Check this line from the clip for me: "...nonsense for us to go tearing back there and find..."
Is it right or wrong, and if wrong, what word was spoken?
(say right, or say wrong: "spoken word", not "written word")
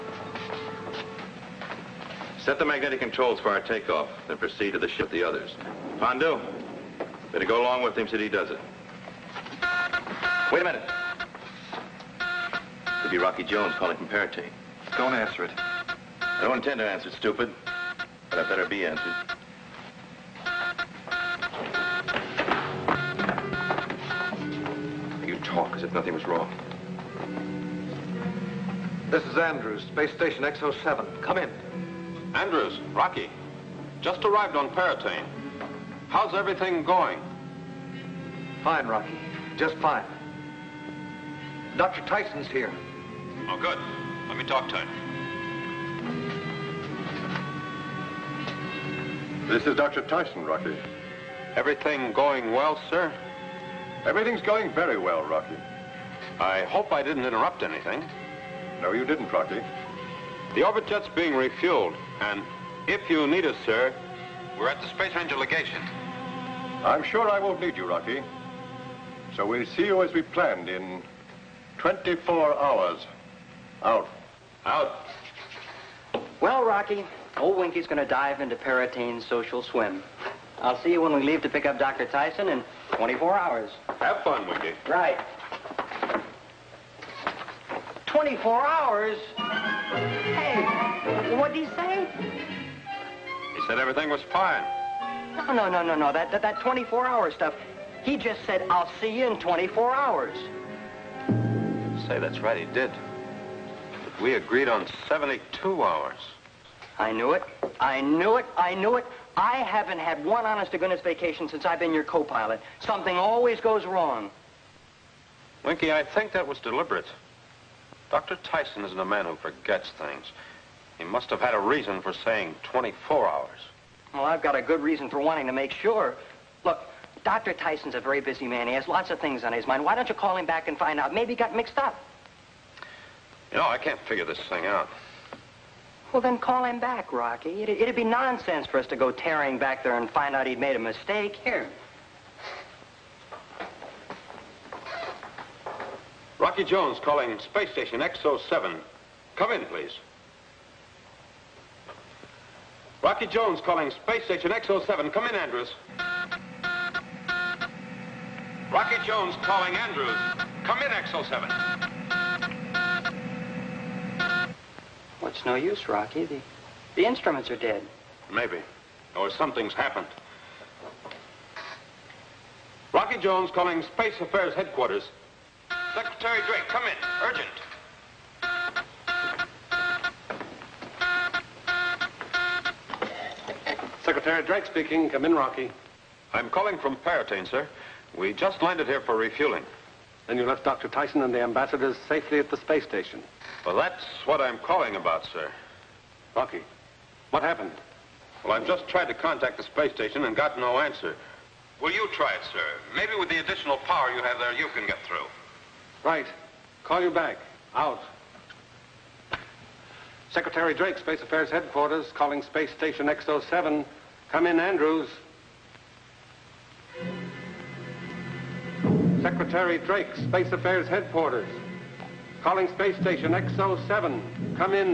right.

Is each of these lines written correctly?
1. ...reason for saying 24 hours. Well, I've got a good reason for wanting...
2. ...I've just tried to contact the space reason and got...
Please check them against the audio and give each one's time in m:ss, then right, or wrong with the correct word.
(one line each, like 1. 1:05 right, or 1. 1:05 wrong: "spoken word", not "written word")
1. 2:01 right
2. 3:18 wrong: "station", not "reason".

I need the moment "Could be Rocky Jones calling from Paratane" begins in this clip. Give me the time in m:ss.
0:13.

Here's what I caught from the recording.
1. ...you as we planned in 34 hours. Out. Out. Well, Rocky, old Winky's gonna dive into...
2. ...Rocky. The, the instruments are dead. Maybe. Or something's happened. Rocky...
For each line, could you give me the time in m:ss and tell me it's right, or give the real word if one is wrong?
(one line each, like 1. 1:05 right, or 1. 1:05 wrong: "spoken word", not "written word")
1. 1:09 wrong: "24", not "34"
2. 2:45 right.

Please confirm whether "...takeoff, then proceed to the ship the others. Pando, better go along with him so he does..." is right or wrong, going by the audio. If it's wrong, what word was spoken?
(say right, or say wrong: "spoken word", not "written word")
right.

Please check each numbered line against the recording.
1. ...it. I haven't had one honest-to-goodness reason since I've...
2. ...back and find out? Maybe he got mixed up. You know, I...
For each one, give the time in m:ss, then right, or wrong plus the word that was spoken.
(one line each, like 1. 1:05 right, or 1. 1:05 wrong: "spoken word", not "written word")
1. 1:48 wrong: "vacation", not "reason"
2. 2:10 right.